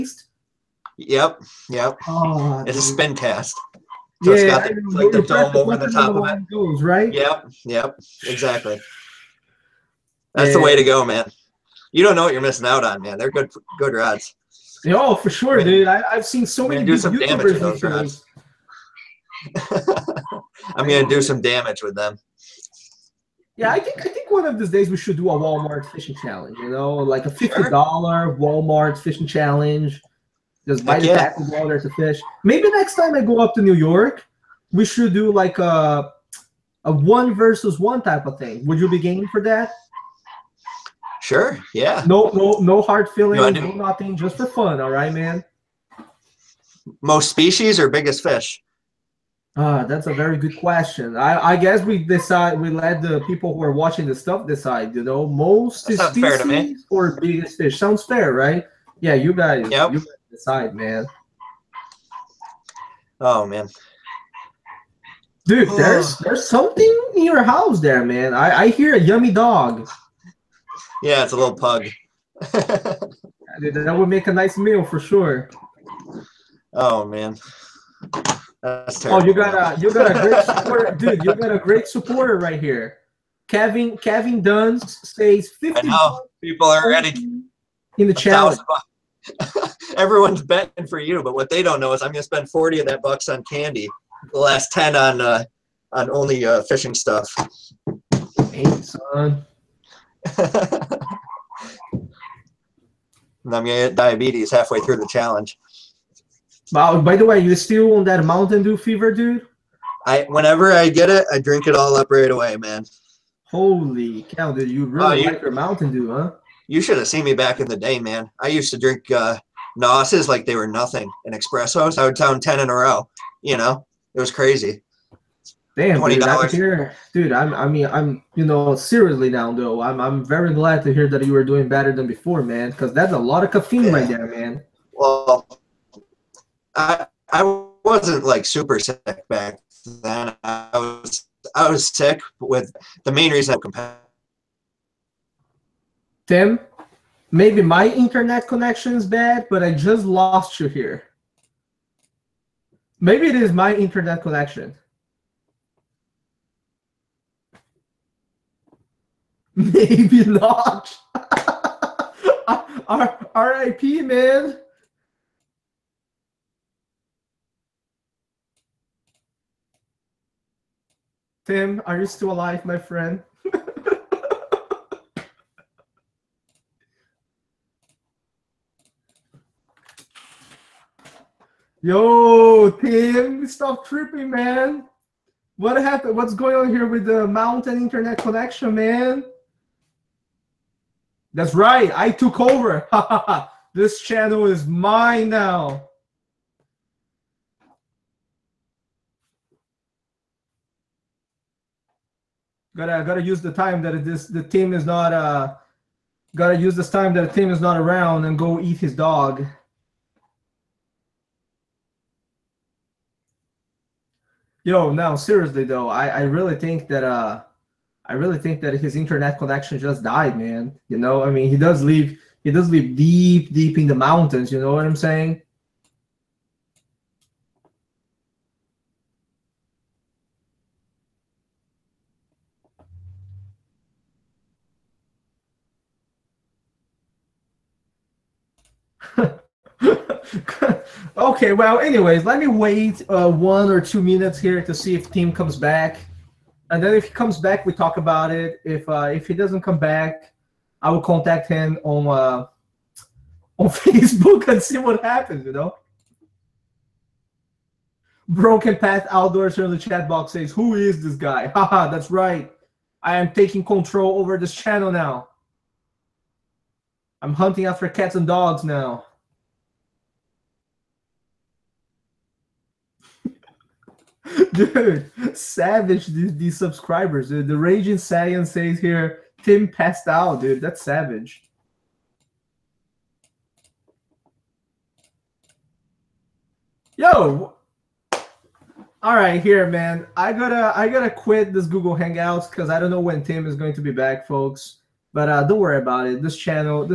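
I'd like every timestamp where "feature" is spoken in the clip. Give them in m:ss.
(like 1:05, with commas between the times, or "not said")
not said.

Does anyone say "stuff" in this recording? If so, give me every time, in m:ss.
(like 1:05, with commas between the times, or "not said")
0:54, 1:36.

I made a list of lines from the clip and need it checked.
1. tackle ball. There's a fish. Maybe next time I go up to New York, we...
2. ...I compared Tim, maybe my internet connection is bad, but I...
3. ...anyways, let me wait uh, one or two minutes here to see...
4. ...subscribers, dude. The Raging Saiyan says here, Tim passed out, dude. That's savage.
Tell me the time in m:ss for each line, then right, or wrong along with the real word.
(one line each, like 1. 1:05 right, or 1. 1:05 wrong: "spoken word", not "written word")
1. 0:31 right
2. 2:23 right
3. 4:01 right
4. 4:36 right.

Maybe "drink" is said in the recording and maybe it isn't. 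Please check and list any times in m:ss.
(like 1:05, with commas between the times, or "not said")
1:51, 1:58.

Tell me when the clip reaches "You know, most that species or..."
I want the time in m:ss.
0:54.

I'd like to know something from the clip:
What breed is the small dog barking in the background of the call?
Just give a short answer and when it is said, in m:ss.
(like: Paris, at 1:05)
Pug, at 1:11.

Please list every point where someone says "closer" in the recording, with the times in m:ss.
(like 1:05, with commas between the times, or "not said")
not said.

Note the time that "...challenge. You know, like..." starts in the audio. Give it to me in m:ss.
0:26.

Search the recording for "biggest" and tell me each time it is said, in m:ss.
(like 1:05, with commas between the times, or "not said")
0:47, 0:57.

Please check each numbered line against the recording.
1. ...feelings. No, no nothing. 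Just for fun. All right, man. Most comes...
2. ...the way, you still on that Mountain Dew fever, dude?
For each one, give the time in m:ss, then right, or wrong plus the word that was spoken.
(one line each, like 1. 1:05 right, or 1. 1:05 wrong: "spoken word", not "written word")
1. 0:43 wrong: "species", not "comes"
2. 1:47 right.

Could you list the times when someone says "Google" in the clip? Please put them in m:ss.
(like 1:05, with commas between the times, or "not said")
4:51.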